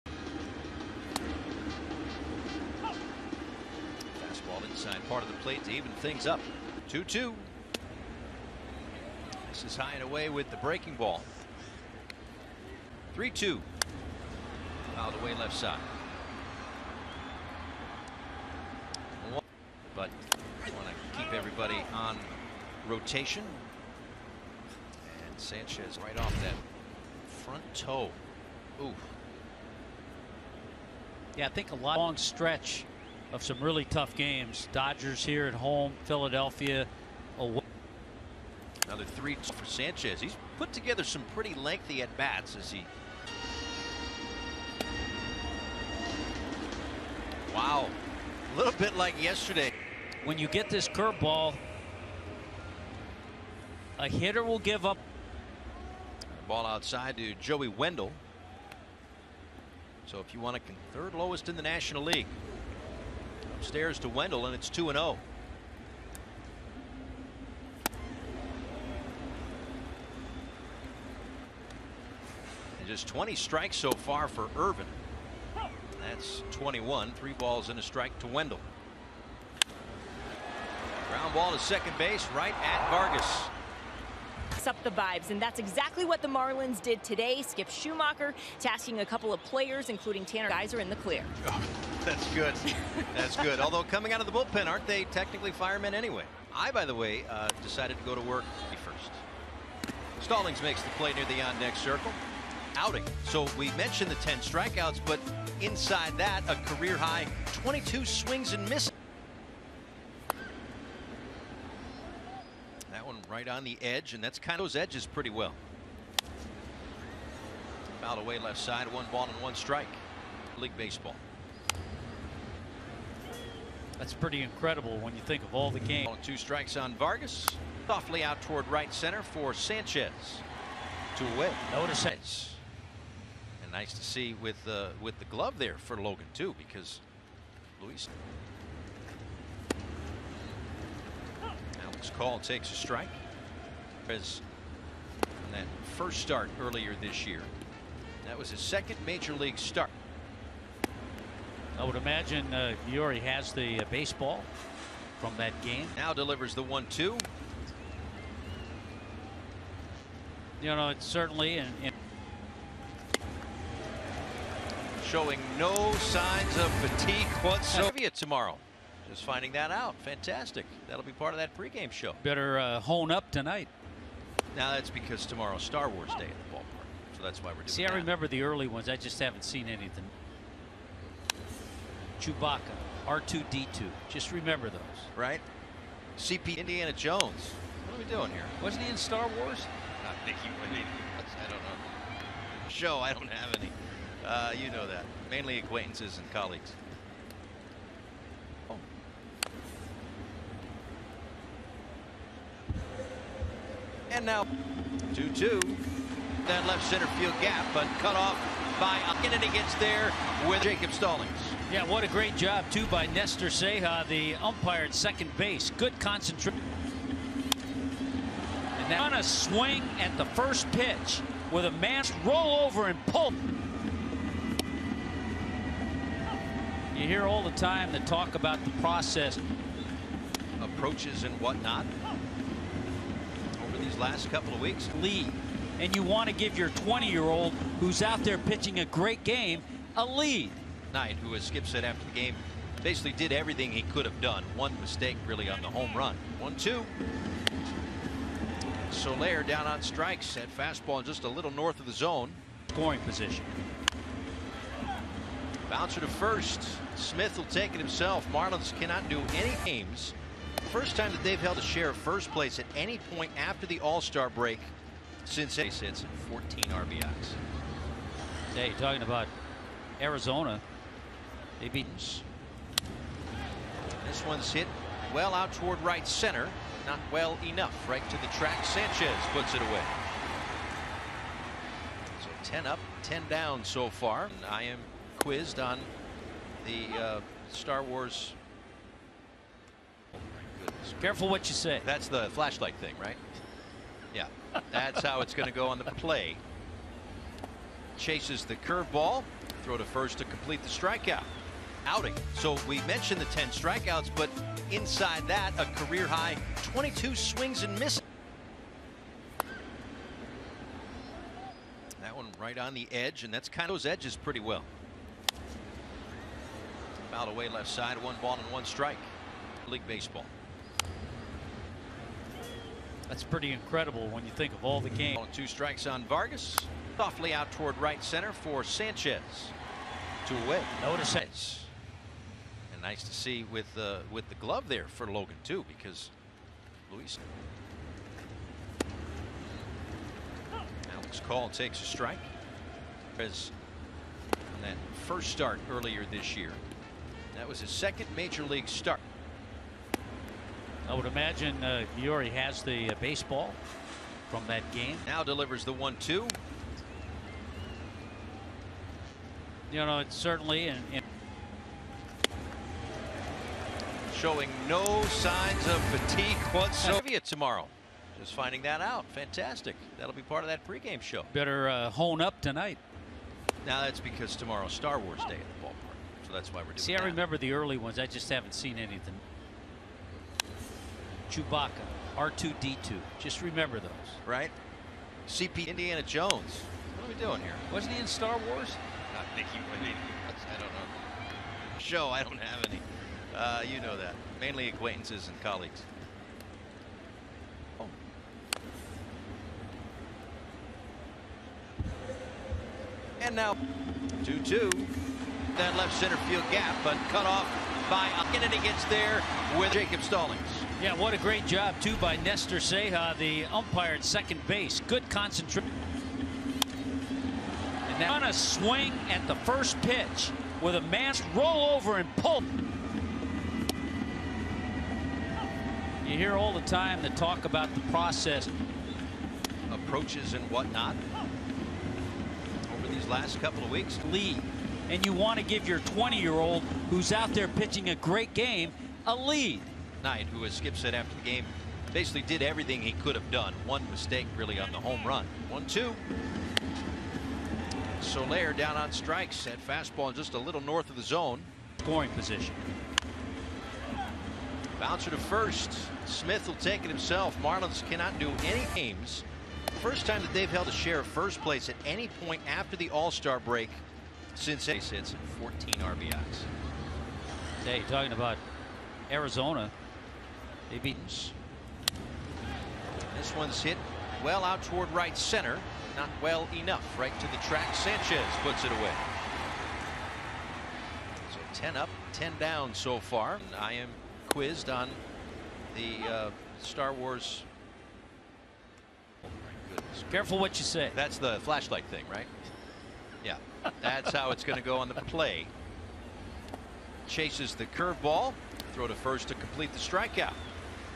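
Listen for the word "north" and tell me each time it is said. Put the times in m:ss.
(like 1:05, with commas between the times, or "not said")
4:11, 7:30.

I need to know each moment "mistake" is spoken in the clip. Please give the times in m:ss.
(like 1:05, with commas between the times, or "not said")
4:04, 7:23.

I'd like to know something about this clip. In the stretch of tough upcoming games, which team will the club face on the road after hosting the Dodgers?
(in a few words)
Philadelphia.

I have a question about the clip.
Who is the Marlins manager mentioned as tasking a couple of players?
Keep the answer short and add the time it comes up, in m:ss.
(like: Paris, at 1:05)
Skip Schumaker, at 1:27.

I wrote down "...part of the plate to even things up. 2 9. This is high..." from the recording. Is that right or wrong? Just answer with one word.
wrong.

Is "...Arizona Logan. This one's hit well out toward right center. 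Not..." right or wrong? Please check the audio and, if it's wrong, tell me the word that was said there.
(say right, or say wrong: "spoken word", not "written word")
wrong: "Evitens", not "Logan".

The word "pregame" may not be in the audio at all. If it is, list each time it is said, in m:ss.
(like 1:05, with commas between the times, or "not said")
2:51, 6:10.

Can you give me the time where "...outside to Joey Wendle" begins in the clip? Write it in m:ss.
0:56.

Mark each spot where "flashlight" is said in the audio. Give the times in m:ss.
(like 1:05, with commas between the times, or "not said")
4:52, 8:11.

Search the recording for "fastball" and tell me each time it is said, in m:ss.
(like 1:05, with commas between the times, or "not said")
4:10, 7:29.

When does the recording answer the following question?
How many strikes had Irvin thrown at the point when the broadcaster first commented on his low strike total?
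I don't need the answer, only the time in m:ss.
1:13.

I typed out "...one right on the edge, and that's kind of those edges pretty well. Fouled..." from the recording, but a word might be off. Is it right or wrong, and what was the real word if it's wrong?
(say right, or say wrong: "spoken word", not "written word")
right.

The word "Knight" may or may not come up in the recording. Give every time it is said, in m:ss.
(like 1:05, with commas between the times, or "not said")
4:00, 7:20.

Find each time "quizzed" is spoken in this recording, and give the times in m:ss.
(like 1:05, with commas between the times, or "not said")
4:45, 8:04.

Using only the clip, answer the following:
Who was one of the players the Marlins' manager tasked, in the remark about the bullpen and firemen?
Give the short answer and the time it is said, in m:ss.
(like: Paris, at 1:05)
Tanner Geiser, at 1:30.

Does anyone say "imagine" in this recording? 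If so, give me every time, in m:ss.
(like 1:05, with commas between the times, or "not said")
2:31, 5:51.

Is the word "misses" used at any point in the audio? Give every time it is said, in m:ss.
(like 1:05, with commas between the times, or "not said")
1:48, 5:07.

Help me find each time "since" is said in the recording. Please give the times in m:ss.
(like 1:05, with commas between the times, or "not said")
4:25, 7:44.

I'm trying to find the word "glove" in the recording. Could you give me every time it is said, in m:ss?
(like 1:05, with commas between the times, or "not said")
2:15, 5:34.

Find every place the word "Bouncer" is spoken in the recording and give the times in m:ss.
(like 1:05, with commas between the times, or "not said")
4:15, 7:34.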